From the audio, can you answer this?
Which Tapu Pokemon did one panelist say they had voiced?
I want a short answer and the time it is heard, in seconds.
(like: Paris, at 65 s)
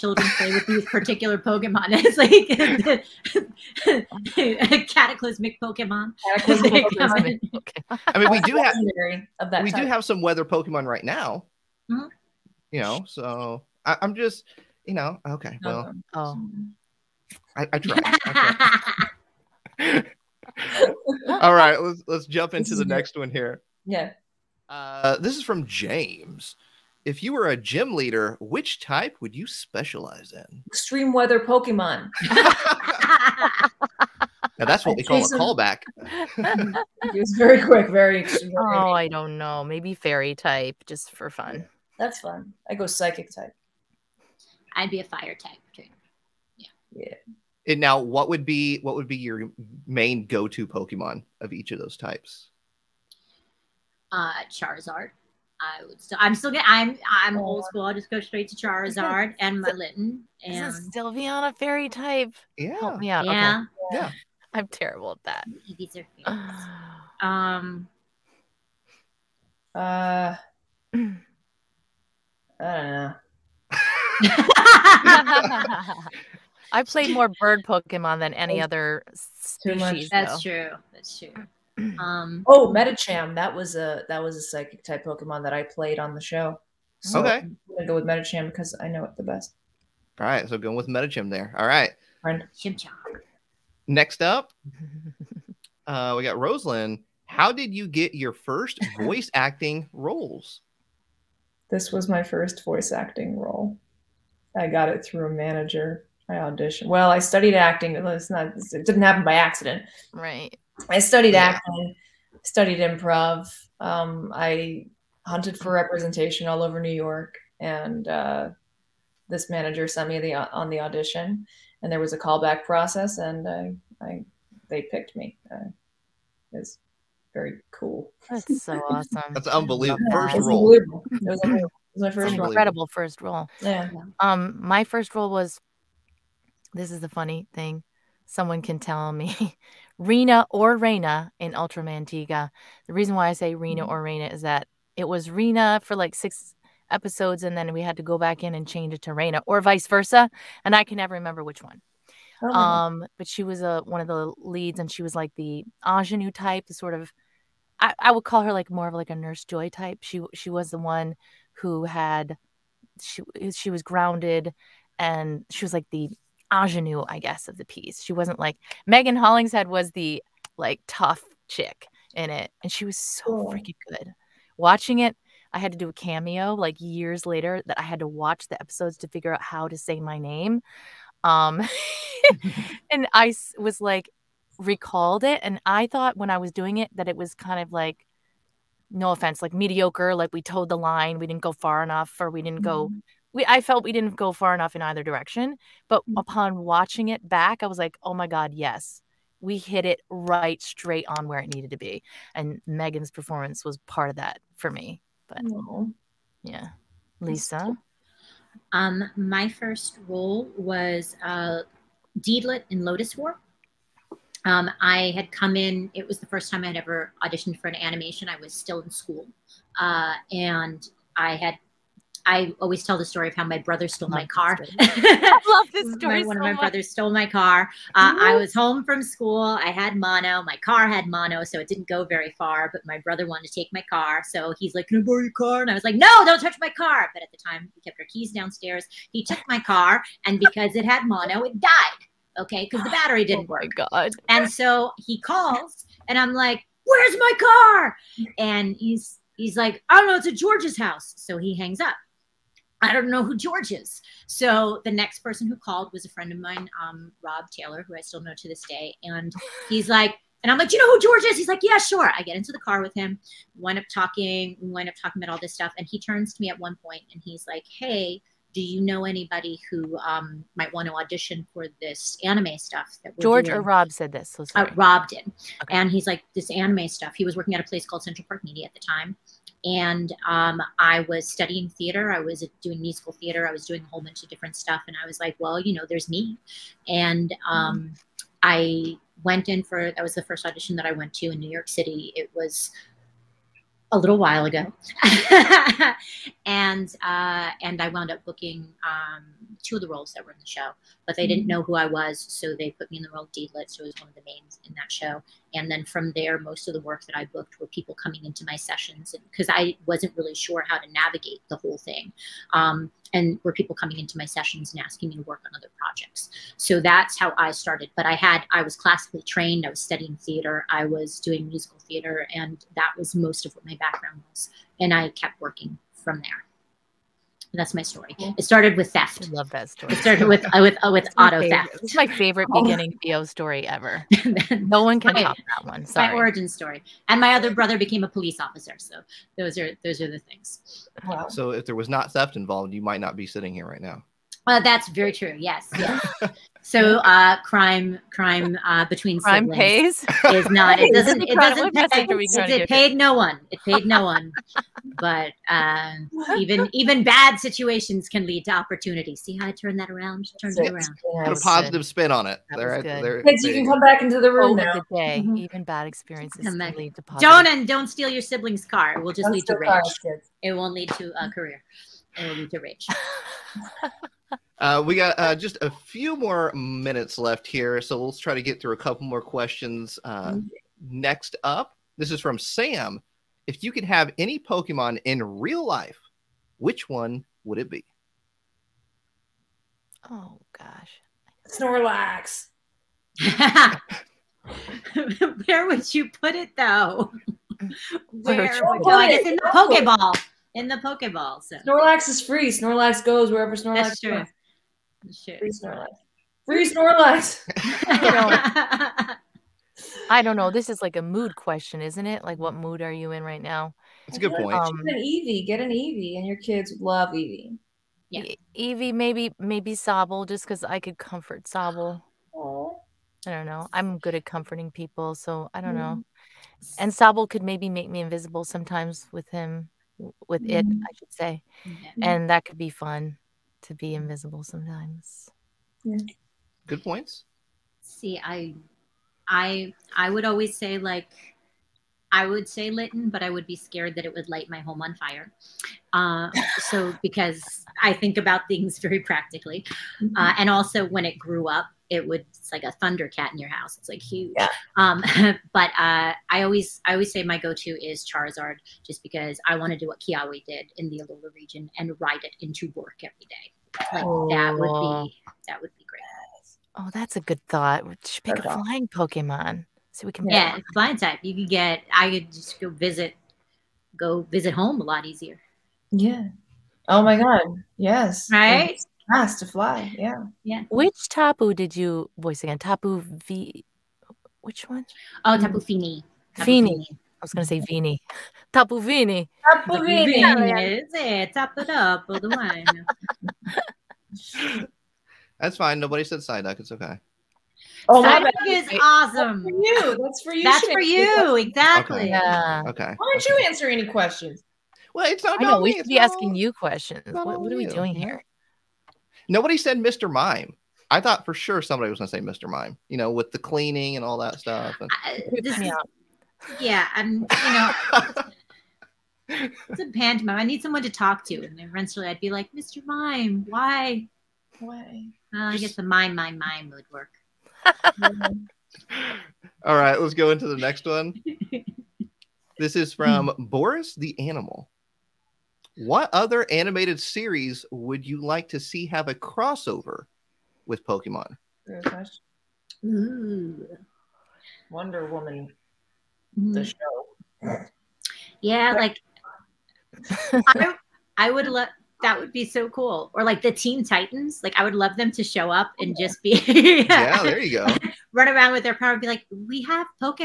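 Tapu Fini, at 485 s.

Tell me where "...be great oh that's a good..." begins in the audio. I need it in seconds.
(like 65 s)
465 s.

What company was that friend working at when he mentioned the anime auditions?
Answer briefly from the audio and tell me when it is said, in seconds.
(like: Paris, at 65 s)
Central Park Media, at 278 s.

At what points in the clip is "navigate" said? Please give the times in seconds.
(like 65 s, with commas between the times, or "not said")
310 s.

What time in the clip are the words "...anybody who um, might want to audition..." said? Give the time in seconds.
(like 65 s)
269 s.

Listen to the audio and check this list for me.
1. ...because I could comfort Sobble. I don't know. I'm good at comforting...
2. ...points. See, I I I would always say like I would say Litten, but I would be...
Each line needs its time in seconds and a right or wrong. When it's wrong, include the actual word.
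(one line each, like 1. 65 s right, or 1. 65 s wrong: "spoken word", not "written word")
1. 420 s right
2. 436 s right.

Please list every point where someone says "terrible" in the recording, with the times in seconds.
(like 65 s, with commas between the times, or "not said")
64 s.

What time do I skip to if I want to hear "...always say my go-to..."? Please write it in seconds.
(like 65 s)
456 s.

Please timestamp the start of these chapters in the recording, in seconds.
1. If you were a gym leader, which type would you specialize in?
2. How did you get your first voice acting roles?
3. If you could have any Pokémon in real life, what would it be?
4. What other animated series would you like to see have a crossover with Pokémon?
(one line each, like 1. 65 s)
1. 23 s
2. 94 s
3. 381 s
4. 532 s.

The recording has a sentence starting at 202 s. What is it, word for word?
And Megan's performance was part of that for me.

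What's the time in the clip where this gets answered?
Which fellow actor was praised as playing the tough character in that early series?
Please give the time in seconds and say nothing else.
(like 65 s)
168 s.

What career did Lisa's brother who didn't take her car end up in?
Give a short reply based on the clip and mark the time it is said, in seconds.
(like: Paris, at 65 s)
Police officer, at 338 s.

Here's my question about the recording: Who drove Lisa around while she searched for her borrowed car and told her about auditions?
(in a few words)
Rob Taylor.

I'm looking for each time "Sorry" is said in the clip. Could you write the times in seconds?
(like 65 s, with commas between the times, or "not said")
335 s.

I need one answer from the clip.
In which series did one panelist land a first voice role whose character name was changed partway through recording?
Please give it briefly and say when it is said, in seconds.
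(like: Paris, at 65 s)
Ultraman Tiga, at 141 s.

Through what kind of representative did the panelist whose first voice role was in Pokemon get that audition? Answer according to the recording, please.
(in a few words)
A manager.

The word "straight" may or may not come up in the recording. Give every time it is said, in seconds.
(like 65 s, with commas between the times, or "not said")
58 s, 200 s.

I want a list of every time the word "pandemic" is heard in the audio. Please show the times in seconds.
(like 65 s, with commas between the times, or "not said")
not said.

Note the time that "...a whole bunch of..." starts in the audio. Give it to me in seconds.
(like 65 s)
283 s.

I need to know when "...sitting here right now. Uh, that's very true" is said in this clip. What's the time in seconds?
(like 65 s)
343 s.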